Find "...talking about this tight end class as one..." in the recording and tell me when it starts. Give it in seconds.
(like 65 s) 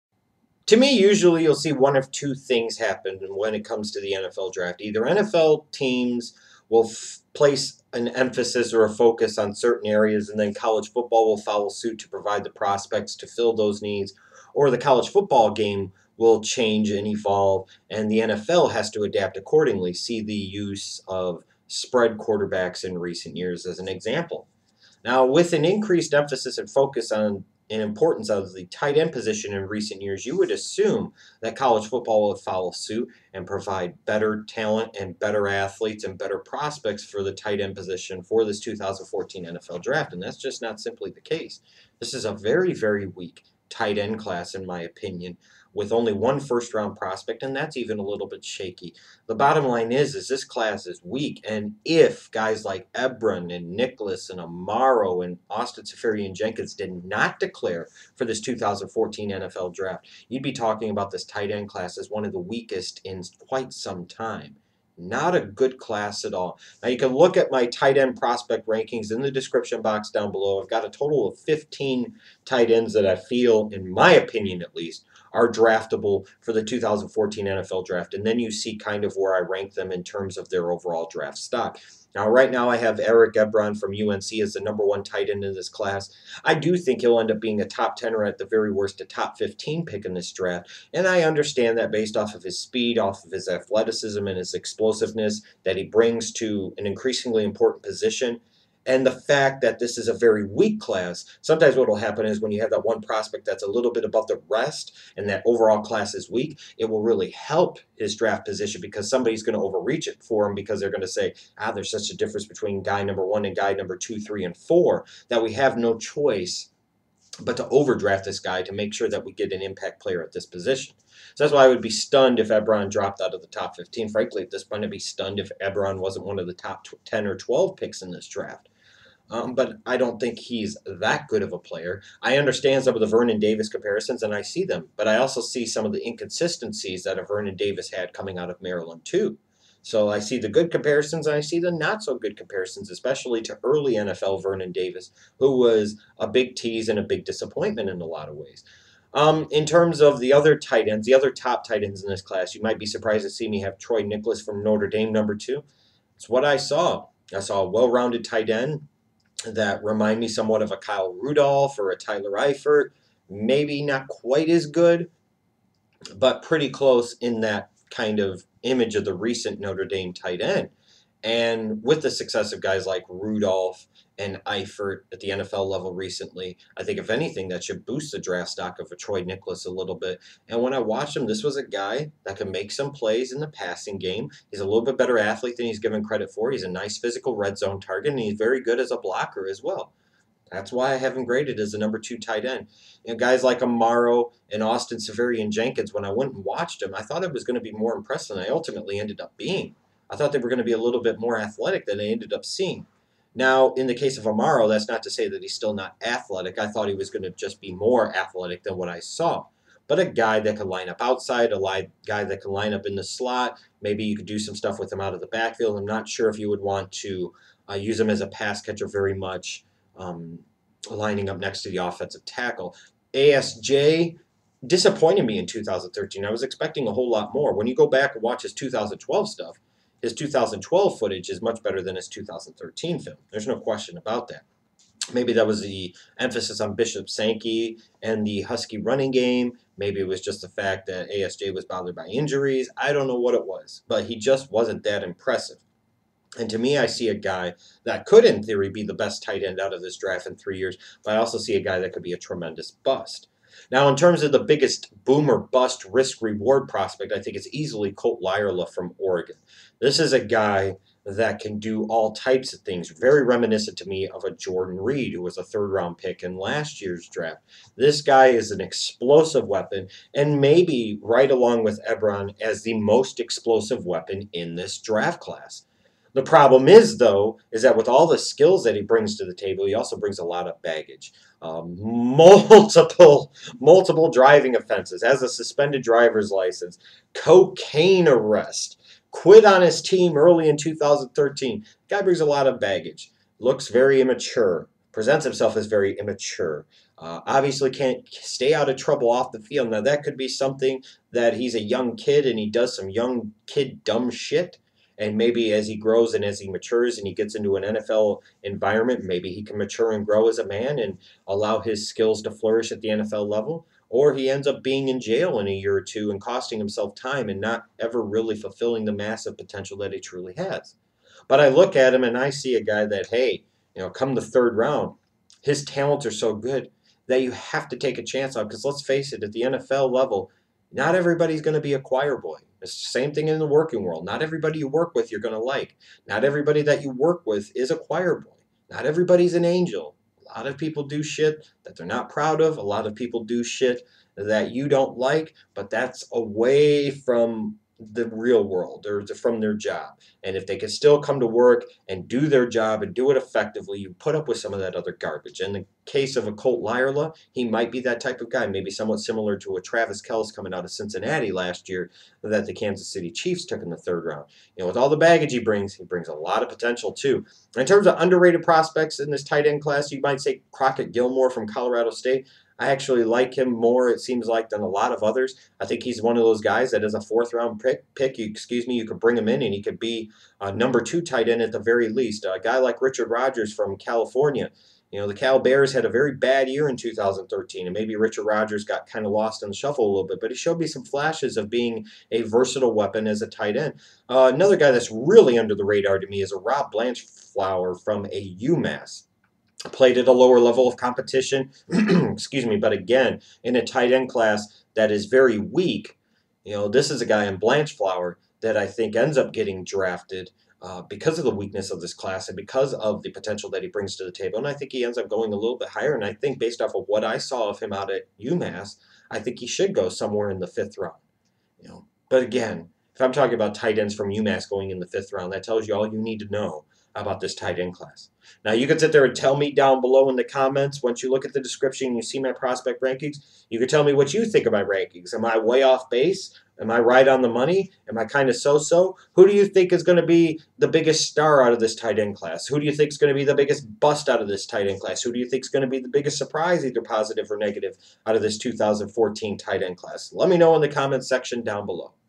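60 s.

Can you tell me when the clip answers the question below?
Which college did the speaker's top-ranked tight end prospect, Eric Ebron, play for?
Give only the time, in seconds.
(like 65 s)
83 s.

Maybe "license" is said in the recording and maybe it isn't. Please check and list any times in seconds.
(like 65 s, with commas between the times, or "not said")
286 s.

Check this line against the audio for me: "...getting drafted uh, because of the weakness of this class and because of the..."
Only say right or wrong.
right.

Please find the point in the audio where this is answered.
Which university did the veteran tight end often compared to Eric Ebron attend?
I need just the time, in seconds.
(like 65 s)
138 s.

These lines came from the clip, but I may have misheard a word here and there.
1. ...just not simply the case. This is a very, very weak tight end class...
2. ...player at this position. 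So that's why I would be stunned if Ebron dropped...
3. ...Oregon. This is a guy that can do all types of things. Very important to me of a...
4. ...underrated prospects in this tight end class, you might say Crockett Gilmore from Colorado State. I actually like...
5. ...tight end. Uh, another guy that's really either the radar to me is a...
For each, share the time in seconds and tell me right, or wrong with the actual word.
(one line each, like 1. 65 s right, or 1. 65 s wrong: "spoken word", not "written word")
1. 40 s right
2. 120 s right
3. 258 s wrong: "reminiscent", not "important"
4. 367 s right
5. 393 s wrong: "under", not "either".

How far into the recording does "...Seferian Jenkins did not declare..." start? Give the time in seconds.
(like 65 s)
55 s.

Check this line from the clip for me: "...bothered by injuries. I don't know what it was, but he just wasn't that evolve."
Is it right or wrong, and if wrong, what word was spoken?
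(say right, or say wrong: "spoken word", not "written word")
wrong: "impressive", not "evolve".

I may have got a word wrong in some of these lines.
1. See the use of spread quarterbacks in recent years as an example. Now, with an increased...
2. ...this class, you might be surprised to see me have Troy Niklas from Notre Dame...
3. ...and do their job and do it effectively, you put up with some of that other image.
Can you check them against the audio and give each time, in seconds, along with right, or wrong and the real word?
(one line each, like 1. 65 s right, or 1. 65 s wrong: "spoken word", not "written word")
1. 19 s right
2. 152 s right
3. 351 s wrong: "garbage", not "image".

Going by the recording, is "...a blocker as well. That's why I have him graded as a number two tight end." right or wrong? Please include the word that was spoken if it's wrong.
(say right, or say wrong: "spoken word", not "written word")
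right.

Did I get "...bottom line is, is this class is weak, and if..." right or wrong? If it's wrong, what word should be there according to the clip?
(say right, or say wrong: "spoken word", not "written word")
right.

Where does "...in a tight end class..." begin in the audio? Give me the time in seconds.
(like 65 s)
403 s.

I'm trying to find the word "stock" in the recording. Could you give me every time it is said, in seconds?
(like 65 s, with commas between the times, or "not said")
81 s, 178 s.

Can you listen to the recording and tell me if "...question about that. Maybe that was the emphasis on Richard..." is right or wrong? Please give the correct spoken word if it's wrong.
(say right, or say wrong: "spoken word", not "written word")
wrong: "Bishop", not "Richard".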